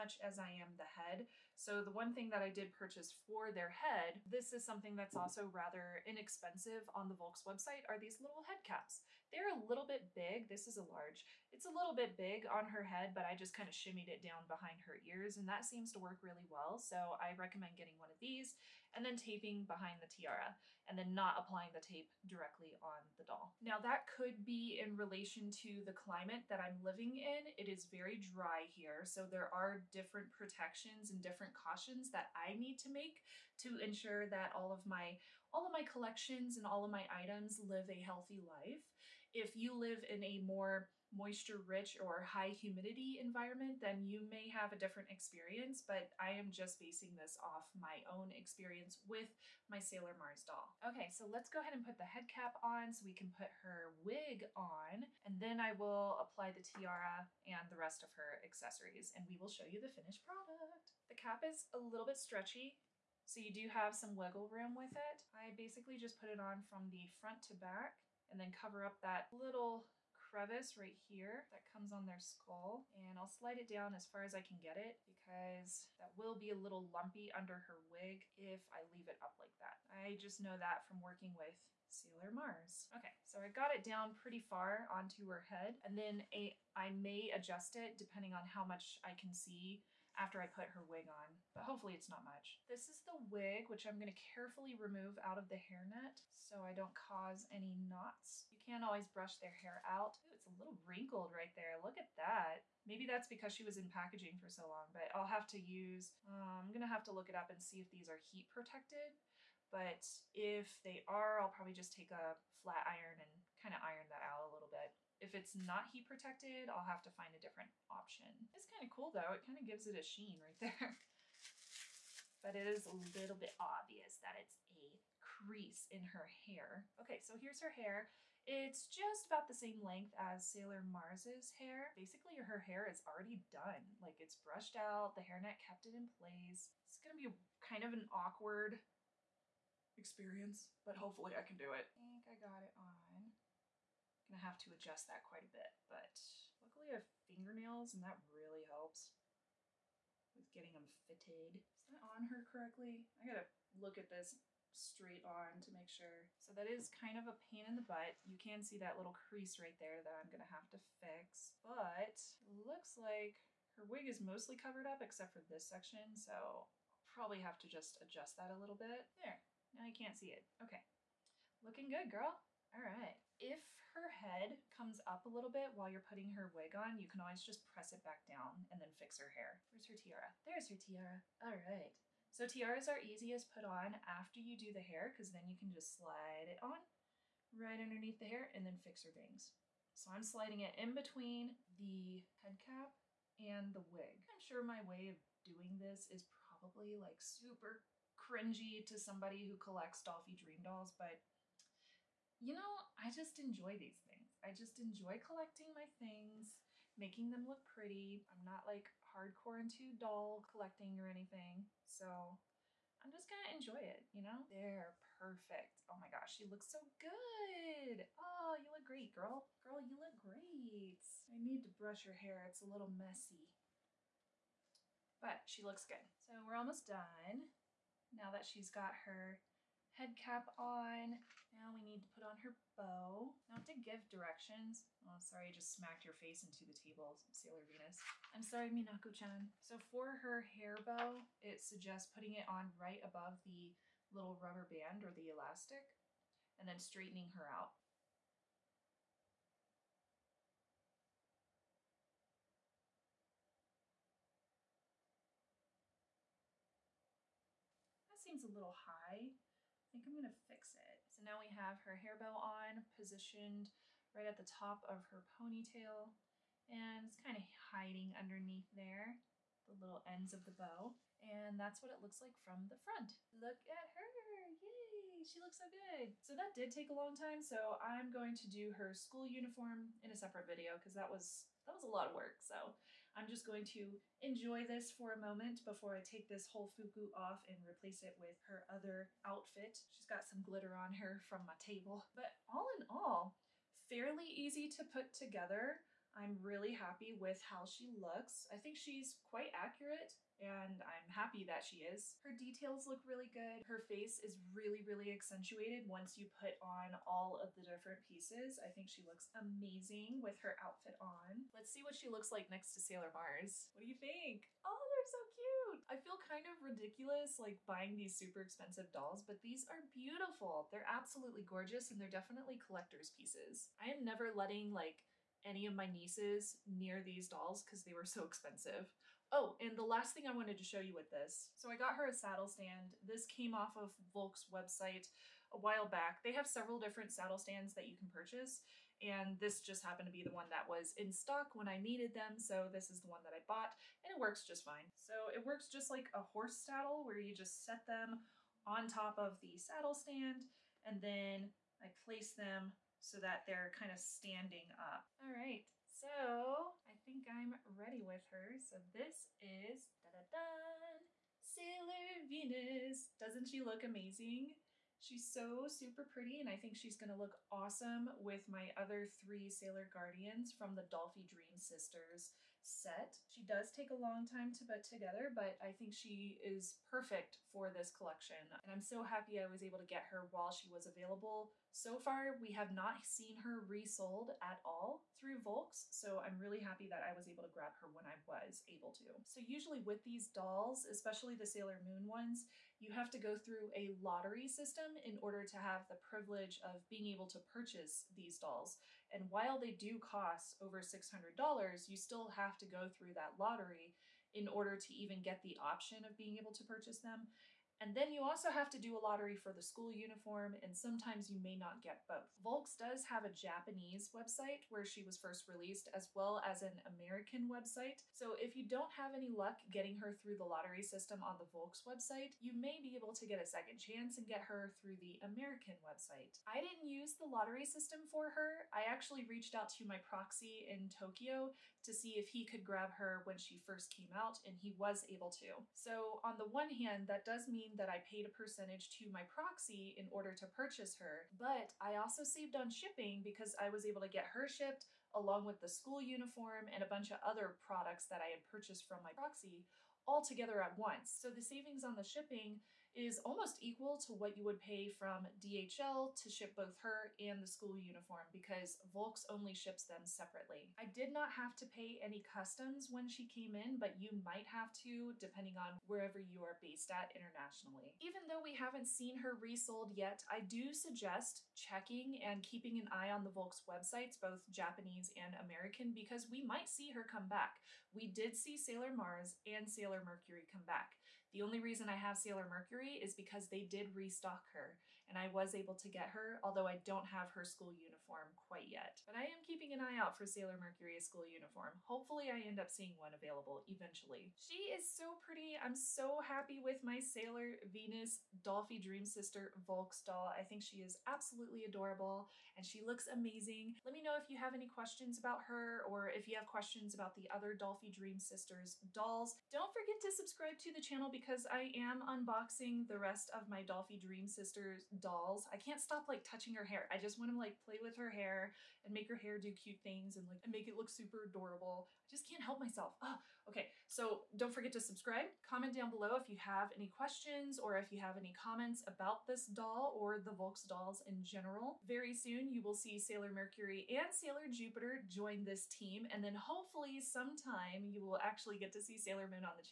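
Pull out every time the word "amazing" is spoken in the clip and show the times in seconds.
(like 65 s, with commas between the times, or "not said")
309 s, 363 s, 503 s.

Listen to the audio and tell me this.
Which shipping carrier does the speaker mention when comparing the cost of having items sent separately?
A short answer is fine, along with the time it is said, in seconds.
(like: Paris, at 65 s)
DHL, at 455 s.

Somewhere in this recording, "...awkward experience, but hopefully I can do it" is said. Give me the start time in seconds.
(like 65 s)
138 s.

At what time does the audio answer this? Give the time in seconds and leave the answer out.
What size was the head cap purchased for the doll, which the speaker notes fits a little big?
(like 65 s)
10 s.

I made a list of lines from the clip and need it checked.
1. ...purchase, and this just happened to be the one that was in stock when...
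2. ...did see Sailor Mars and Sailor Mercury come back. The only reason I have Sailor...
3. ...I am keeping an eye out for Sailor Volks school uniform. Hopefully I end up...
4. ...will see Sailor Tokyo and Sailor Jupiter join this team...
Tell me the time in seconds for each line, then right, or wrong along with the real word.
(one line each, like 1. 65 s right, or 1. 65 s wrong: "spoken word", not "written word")
1. 338 s right
2. 478 s right
3. 489 s wrong: "Mercury", not "Volks"
4. 532 s wrong: "Mercury", not "Tokyo".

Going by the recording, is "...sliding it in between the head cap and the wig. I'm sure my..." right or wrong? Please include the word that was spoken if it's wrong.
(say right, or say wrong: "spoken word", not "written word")
right.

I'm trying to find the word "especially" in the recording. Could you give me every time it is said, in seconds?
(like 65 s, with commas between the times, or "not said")
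390 s.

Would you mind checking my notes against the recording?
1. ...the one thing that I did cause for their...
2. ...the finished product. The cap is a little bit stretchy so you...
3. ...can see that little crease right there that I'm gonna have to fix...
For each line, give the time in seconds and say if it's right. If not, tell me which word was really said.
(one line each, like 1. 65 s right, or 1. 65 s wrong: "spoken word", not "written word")
1. 1 s wrong: "purchase", not "cause"
2. 59 s right
3. 158 s right.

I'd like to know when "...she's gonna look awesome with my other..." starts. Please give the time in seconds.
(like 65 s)
366 s.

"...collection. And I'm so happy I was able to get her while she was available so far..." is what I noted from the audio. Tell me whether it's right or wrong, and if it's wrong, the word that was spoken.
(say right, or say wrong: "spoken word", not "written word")
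right.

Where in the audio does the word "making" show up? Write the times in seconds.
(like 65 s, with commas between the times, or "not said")
206 s.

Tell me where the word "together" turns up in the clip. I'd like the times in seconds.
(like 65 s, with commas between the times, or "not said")
295 s, 374 s, 450 s.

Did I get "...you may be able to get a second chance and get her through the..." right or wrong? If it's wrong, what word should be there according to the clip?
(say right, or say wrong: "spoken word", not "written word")
right.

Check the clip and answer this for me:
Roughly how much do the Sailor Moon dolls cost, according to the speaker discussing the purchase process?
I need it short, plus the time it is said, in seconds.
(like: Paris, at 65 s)
Over $600, at 400 s.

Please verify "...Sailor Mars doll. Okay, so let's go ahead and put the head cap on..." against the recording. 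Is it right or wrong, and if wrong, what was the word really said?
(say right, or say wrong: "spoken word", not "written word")
right.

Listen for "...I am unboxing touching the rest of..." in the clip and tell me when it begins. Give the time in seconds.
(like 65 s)
511 s.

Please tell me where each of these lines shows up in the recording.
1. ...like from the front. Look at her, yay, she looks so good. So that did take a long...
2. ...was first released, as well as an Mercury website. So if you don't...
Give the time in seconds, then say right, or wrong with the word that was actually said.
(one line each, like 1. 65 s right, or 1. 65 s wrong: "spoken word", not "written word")
1. 272 s right
2. 415 s wrong: "American", not "Mercury".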